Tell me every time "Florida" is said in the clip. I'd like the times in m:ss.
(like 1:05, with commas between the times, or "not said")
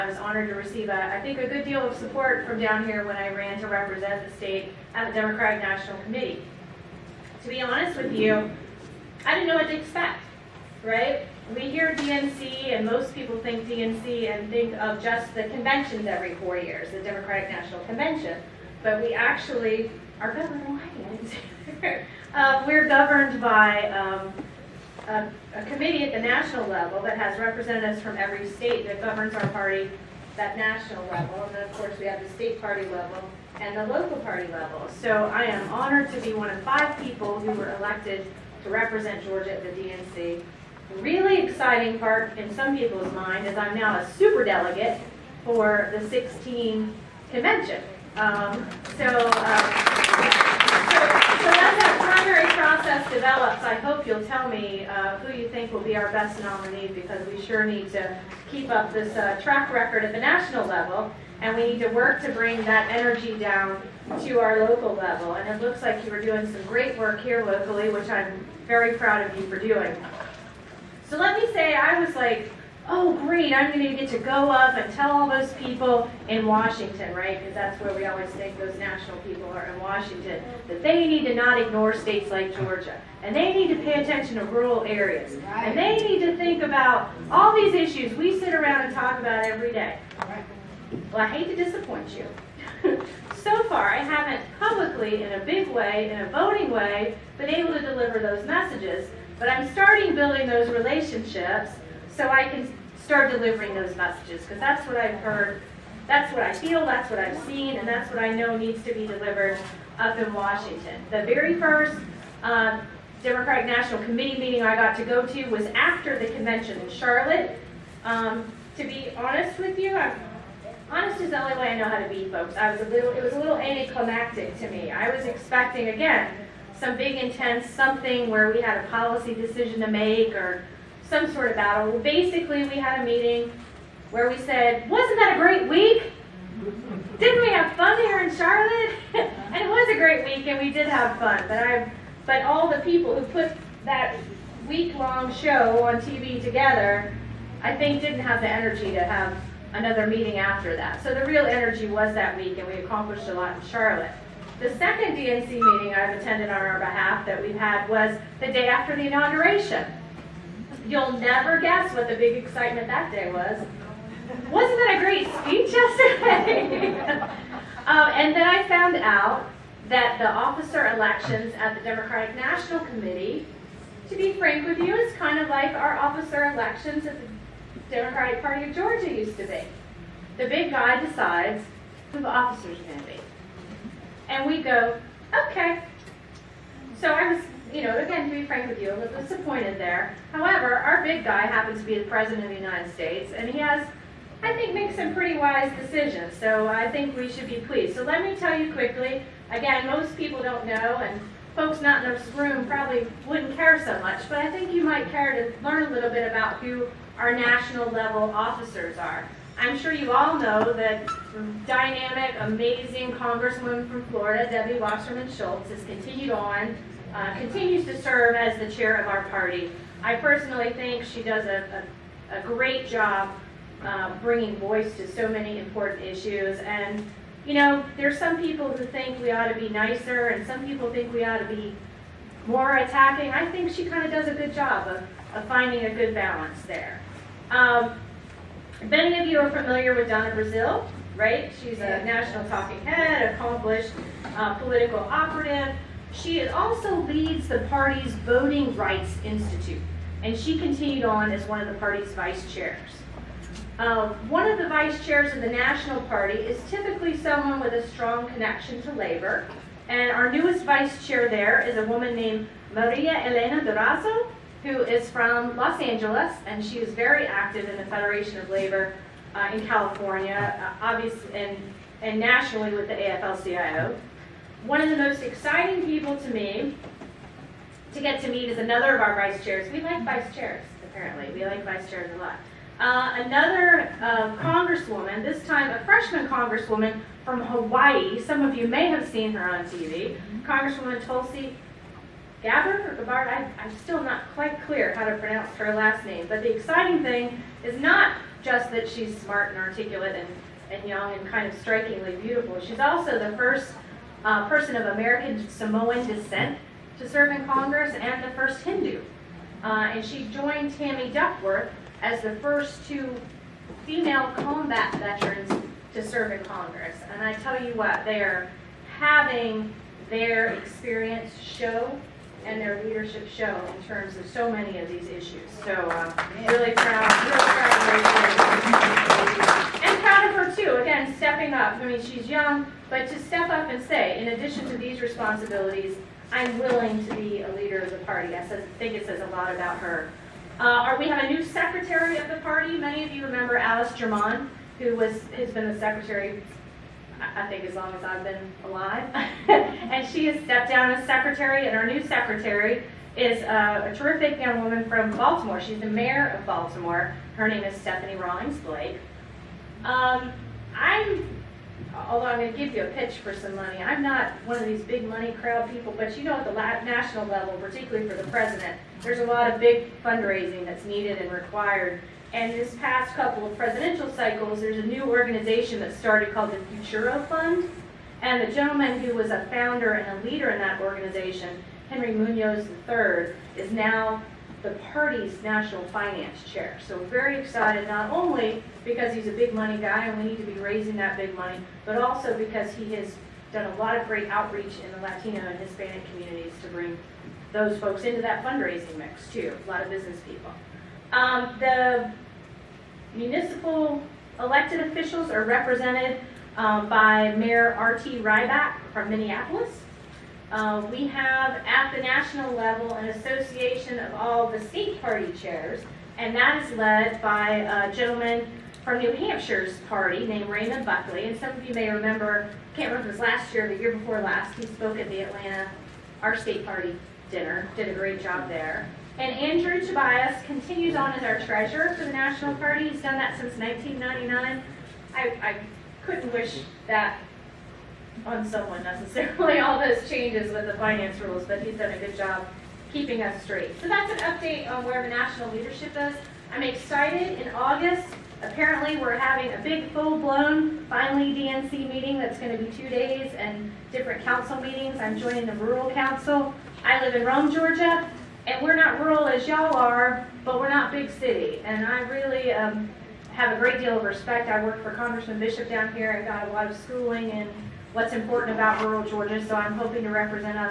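3:34.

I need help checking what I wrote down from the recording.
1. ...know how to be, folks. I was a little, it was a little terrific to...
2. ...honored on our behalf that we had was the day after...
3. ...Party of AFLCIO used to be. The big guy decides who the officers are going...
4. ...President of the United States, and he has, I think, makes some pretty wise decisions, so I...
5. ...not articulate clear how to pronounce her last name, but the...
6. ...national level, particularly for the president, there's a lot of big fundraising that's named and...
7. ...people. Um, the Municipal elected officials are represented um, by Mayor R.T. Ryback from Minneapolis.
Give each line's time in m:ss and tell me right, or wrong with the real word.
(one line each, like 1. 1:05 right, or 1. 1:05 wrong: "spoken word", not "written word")
1. 2:01 wrong: "anticlimactic", not "terrific"
2. 2:36 wrong: "attended", not "honored"
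3. 2:58 wrong: "Georgia", not "AFLCIO"
4. 3:12 right
5. 4:54 wrong: "quite", not "articulate"
6. 6:06 wrong: "needed", not "named"
7. 6:40 right.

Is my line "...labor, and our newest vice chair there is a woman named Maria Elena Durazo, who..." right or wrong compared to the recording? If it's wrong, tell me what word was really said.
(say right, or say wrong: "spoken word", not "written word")
right.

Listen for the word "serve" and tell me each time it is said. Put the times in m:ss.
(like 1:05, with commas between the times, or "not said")
3:38, 5:07, 5:16.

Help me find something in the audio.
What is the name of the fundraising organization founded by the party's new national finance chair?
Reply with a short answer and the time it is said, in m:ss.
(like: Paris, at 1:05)
Futuro Fund, at 6:16.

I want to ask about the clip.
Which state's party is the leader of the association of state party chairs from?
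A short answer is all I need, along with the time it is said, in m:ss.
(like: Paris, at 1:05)
New Hampshire, at 6:58.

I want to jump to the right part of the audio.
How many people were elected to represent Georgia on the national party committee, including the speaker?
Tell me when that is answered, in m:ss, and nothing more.
0:36.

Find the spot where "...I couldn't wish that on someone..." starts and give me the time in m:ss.
7:15.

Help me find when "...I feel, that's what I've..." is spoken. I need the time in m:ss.
1:46.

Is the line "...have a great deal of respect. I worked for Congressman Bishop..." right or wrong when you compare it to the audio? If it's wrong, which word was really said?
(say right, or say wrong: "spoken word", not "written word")
right.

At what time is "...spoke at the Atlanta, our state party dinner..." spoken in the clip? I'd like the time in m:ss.
7:04.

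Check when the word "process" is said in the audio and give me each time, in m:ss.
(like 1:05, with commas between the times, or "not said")
0:52.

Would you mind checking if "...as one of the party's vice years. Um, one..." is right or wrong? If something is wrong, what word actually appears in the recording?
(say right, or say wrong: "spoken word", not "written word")
wrong: "chairs", not "years".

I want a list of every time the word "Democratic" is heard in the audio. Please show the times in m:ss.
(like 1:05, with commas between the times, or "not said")
0:05, 0:16, 1:53, 2:51, 2:57.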